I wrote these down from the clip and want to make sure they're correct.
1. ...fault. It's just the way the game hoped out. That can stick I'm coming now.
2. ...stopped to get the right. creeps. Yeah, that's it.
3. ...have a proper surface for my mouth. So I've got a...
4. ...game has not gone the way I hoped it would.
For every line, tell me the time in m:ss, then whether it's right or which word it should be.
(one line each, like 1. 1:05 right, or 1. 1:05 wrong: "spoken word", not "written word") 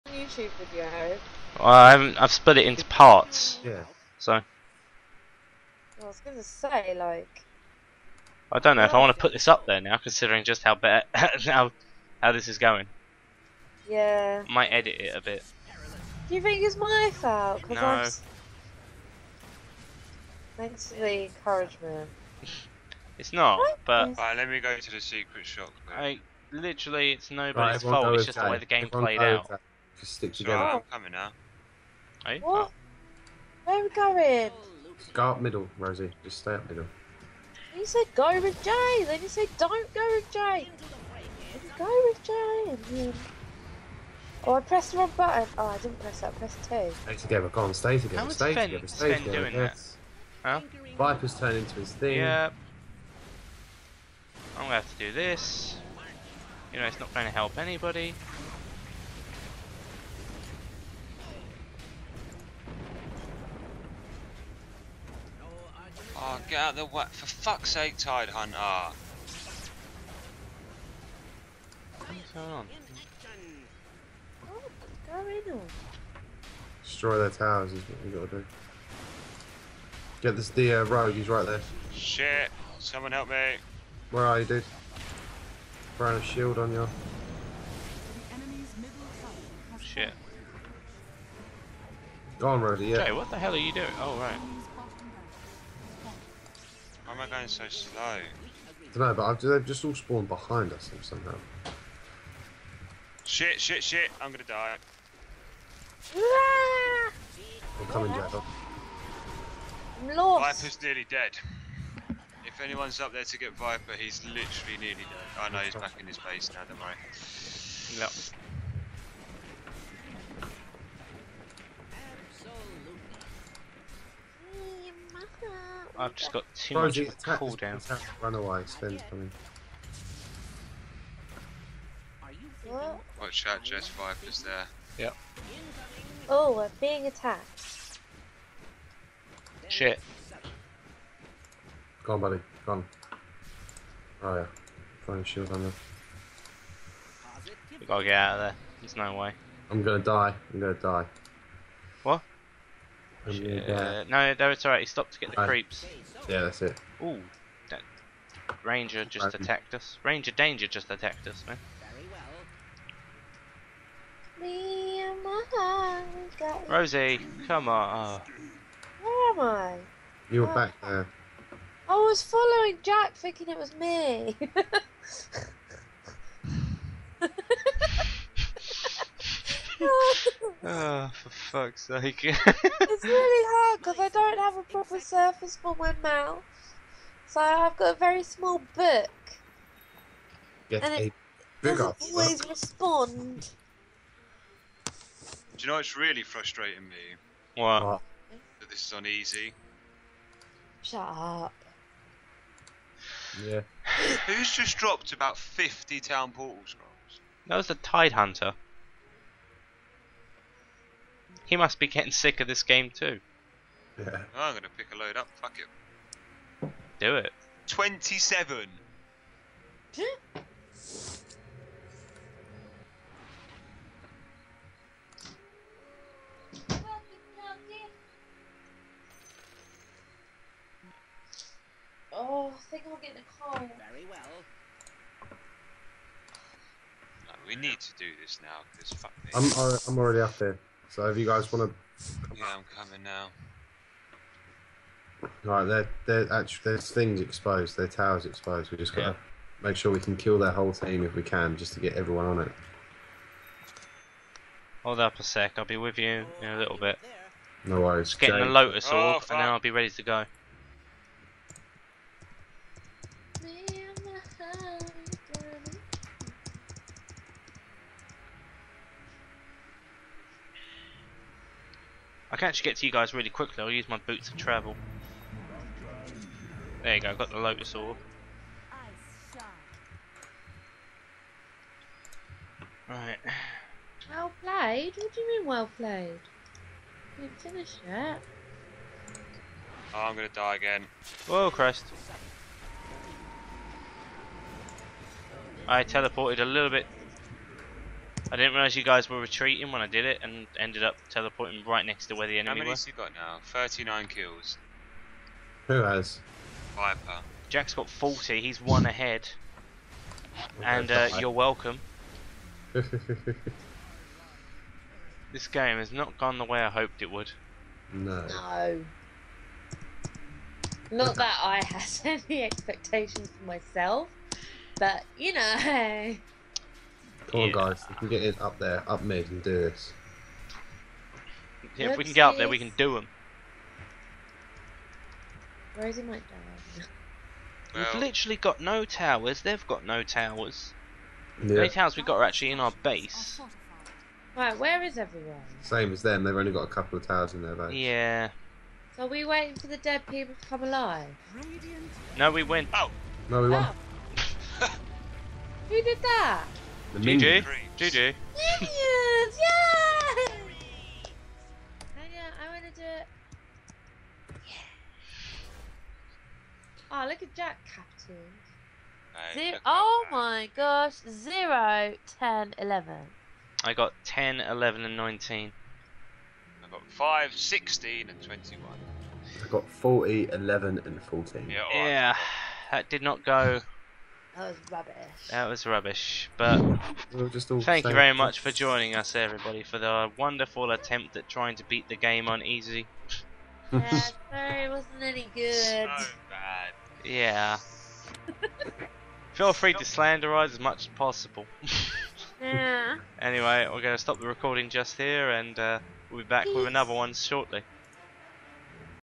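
1. 0:27 wrong: "played", not "hoped"
2. 2:34 right
3. 3:04 right
4. 5:15 right.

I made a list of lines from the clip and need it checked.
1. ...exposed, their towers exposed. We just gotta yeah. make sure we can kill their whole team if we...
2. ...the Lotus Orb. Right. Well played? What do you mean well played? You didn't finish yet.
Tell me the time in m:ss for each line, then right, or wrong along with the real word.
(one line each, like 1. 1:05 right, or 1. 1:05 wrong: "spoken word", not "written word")
1. 4:07 right
2. 4:37 right.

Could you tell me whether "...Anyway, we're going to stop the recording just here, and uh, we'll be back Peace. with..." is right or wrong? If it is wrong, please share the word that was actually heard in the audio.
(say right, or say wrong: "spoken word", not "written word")
right.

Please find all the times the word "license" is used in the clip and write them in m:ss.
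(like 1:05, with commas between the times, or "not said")
not said.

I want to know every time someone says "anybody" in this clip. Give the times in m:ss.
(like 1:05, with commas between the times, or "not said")
0:57.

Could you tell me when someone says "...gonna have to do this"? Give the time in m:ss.
0:54.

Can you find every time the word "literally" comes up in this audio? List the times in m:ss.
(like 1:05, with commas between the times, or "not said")
0:26, 1:54, 5:38.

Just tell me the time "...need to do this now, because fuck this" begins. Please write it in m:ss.
3:57.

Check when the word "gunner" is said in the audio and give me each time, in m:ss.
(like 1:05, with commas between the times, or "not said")
not said.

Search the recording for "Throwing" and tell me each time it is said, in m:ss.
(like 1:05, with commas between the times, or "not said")
1:25, 2:25.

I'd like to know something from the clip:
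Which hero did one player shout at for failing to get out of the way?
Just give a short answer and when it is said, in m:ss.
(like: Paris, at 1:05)
Tidehunter, at 1:07.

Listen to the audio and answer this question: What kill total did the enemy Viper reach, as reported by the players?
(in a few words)
39.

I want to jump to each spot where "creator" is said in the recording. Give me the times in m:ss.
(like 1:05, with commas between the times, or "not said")
not said.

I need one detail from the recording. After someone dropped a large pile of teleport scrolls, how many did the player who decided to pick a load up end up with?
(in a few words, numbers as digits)
27.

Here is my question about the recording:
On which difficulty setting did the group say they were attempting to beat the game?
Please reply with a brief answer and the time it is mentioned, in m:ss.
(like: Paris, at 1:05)
easy, at 6:32.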